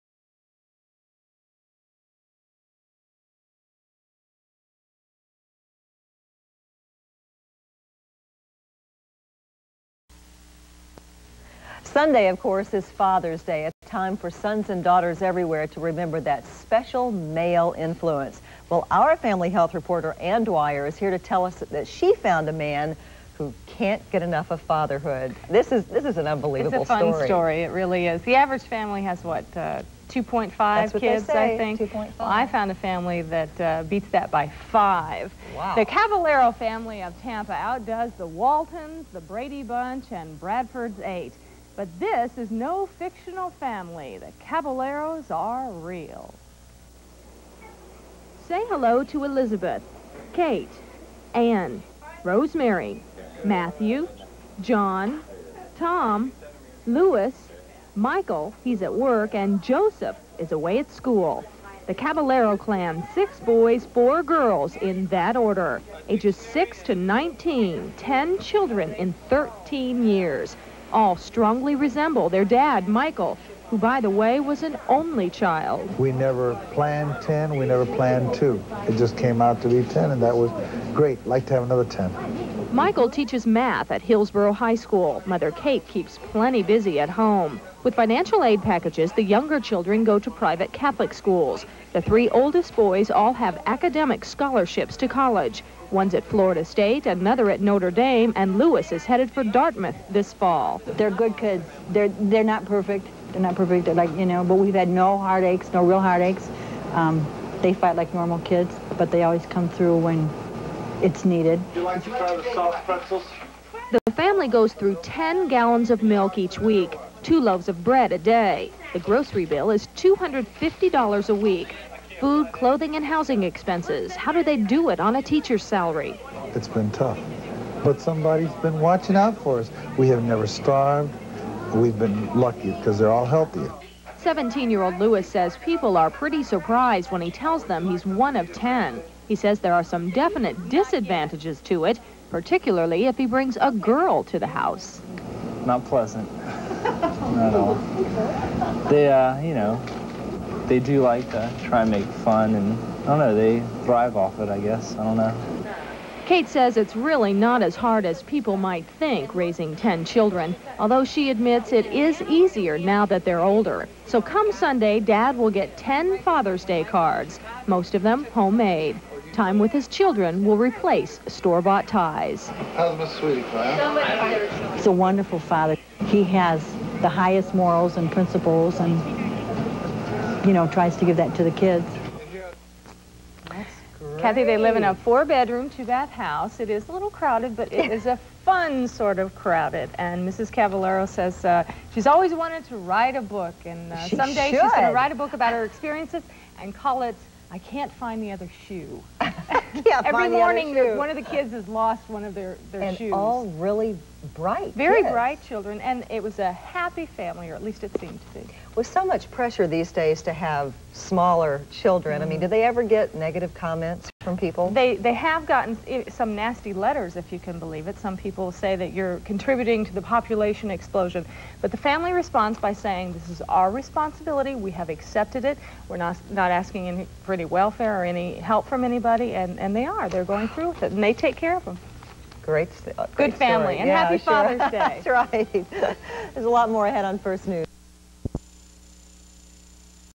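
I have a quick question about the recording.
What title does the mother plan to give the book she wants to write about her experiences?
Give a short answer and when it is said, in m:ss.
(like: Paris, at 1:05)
I Can't Find the Other Shoe, at 3:17.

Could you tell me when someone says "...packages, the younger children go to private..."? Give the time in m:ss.
1:28.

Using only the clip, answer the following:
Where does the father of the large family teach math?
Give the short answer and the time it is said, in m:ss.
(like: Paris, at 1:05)
Hillsborough High School, at 1:24.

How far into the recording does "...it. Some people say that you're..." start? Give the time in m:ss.
3:37.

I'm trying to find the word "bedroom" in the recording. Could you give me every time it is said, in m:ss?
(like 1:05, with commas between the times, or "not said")
3:04.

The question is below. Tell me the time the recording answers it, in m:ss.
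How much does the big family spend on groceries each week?
1:59.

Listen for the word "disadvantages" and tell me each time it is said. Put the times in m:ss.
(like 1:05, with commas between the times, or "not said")
2:20.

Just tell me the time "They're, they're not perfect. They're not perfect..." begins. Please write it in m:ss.
1:41.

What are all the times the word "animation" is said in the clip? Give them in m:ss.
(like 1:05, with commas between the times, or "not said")
not said.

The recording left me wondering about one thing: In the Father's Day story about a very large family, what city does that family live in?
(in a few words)
Tampa.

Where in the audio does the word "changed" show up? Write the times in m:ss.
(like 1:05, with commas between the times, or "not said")
not said.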